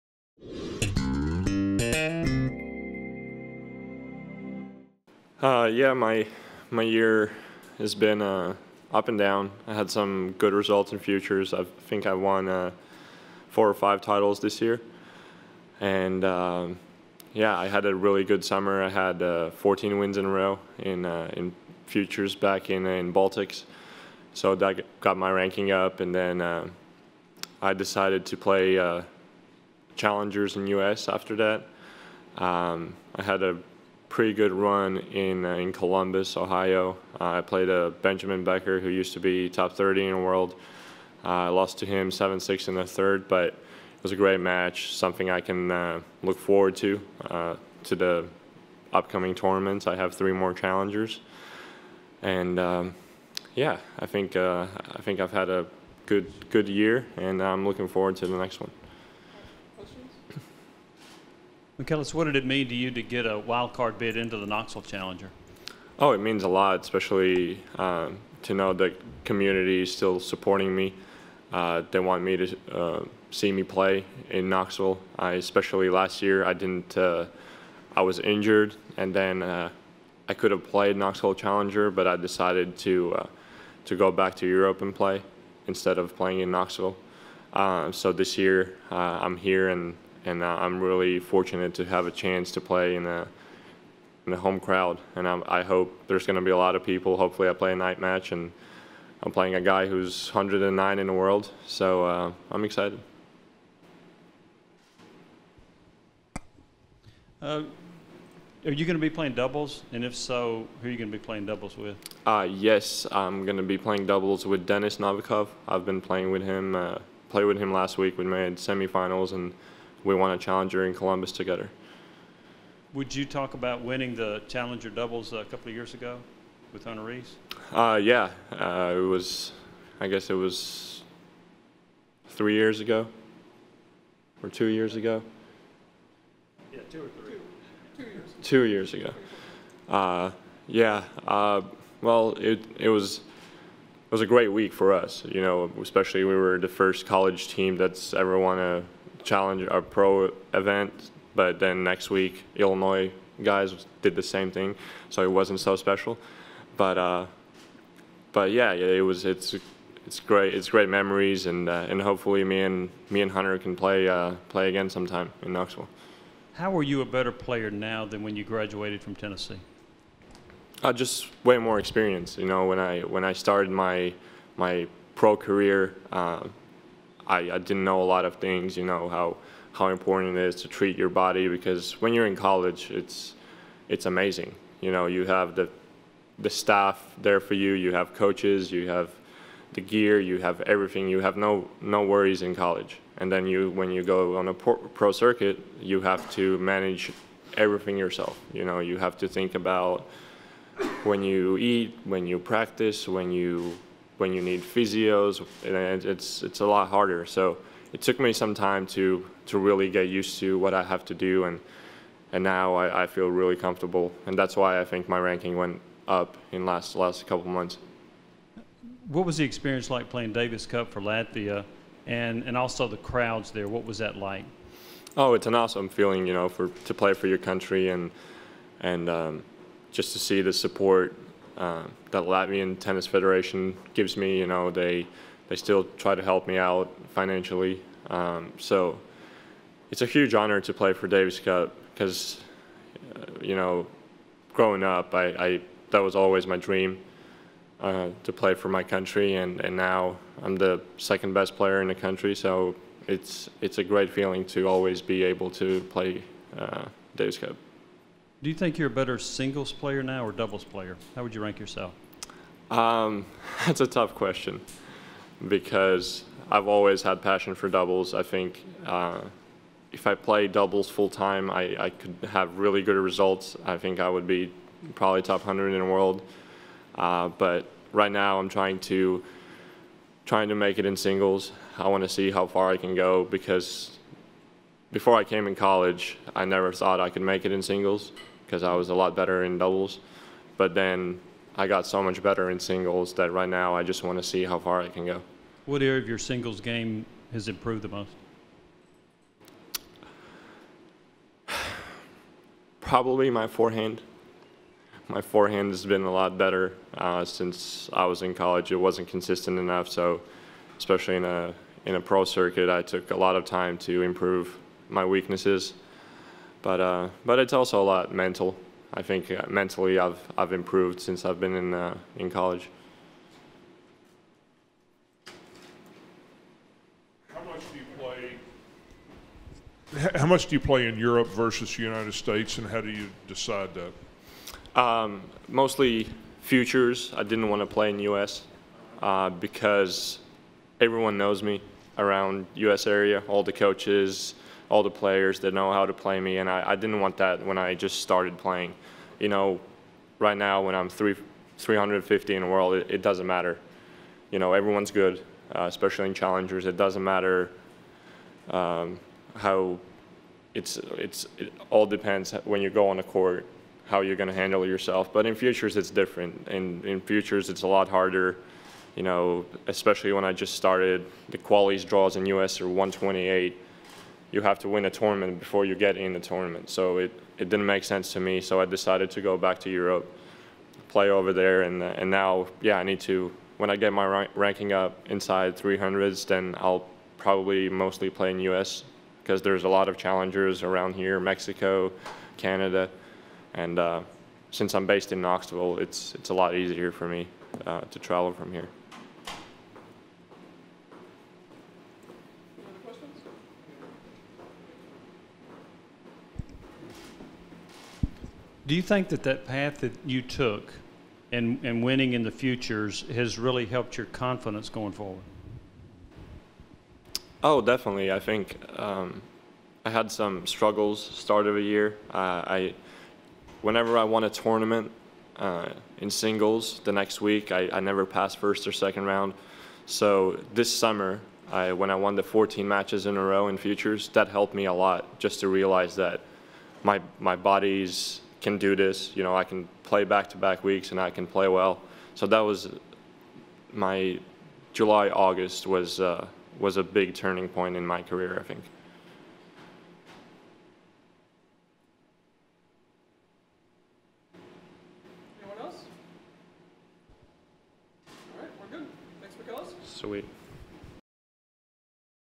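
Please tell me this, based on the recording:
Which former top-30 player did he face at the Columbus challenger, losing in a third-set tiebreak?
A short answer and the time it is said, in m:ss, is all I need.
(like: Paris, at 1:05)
Benjamin Becker, at 0:38.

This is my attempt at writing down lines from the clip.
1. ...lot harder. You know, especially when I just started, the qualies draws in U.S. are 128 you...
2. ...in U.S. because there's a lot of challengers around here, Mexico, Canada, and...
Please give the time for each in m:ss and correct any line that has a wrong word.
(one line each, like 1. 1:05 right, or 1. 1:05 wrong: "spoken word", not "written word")
1. 6:07 right
2. 6:28 right.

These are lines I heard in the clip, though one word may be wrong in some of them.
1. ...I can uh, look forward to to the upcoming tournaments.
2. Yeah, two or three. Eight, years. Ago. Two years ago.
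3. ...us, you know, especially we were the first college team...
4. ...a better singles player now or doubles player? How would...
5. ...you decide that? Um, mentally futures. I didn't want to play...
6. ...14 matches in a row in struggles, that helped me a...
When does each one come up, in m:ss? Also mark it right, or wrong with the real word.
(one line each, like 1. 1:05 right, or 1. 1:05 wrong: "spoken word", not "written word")
1. 0:45 right
2. 2:16 wrong: "Two", not "Eight"
3. 2:24 right
4. 4:18 right
5. 5:32 wrong: "mostly", not "mentally"
6. 7:12 wrong: "futures", not "struggles".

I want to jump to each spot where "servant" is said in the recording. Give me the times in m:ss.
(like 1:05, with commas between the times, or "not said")
not said.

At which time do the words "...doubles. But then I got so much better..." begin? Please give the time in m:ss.
4:49.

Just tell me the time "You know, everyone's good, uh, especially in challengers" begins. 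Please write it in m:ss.
5:54.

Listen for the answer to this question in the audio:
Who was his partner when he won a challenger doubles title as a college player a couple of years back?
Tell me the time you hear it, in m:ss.
2:06.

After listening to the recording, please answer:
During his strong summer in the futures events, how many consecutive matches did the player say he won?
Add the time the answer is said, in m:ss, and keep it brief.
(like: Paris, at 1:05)
14, at 0:19.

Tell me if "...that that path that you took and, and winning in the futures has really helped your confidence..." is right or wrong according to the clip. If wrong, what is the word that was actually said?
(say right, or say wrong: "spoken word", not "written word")
right.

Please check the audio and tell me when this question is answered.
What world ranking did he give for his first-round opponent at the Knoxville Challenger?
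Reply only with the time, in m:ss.
1:40.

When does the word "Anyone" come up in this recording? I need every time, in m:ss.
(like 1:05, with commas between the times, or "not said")
7:35.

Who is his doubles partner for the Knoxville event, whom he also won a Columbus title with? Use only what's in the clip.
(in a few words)
Dennis Novikov.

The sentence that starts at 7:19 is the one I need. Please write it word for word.
You know, I can play back-to-back weeks and I can play well.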